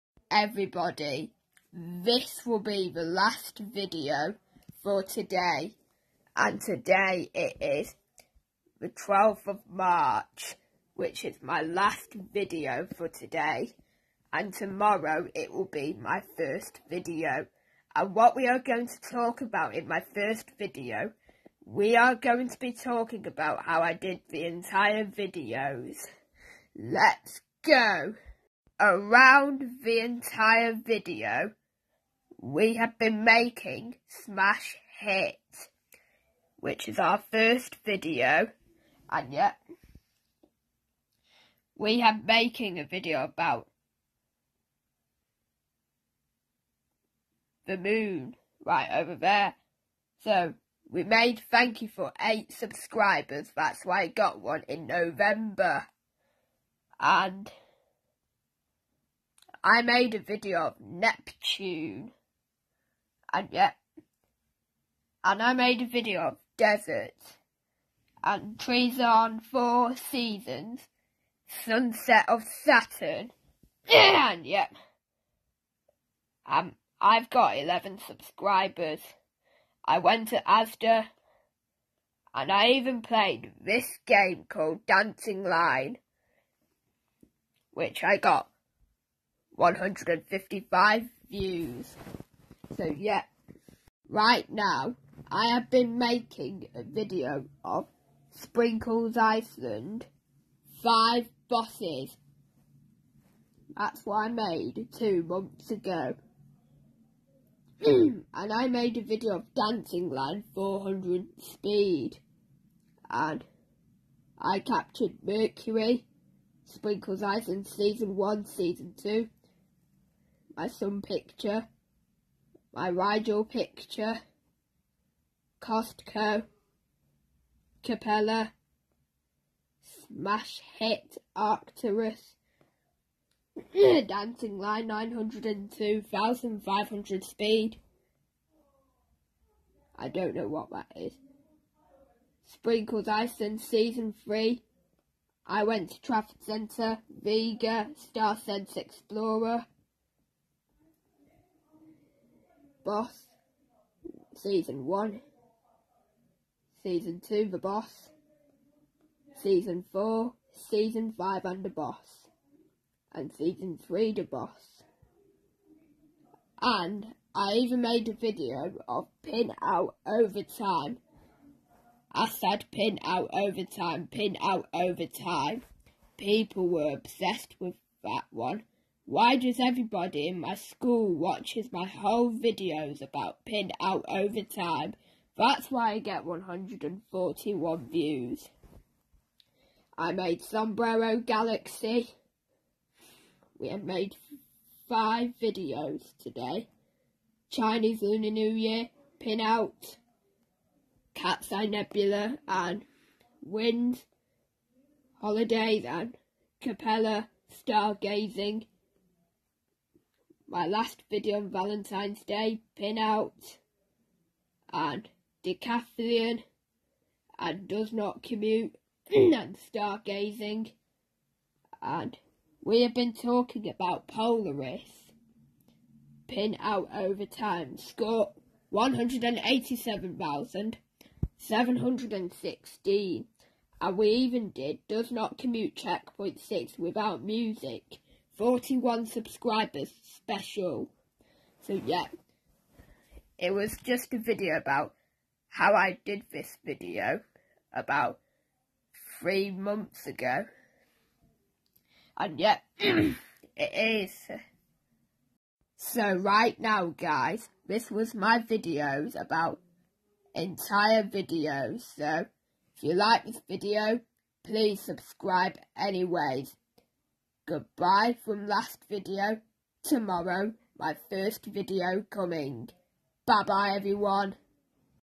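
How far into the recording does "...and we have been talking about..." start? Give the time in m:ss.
3:41.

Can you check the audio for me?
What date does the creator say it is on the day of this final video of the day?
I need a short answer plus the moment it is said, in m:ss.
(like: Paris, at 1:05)
12th of March, at 0:08.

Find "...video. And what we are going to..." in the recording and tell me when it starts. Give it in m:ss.
0:16.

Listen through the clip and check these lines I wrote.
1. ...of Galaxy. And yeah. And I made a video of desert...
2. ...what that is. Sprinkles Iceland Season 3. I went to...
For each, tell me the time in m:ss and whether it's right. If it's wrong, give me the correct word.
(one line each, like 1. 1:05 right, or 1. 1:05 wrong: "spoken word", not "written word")
1. 1:00 wrong: "Neptune", not "Galaxy"
2. 2:20 right.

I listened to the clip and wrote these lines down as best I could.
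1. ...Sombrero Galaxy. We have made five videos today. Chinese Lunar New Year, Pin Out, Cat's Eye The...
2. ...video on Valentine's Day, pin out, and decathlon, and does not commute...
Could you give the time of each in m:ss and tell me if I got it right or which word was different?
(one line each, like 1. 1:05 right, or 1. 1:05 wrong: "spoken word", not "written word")
1. 3:10 wrong: "Nebula", not "The"
2. 3:31 right.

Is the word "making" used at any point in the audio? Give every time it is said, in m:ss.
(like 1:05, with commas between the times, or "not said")
0:33, 0:42, 1:35.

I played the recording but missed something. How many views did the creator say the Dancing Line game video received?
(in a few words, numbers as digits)
155.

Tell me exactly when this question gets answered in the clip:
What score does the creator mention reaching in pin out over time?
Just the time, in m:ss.
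3:48.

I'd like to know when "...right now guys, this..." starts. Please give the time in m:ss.
4:16.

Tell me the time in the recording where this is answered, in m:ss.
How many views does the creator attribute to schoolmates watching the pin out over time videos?
3:06.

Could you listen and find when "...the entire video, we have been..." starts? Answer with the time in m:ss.
0:29.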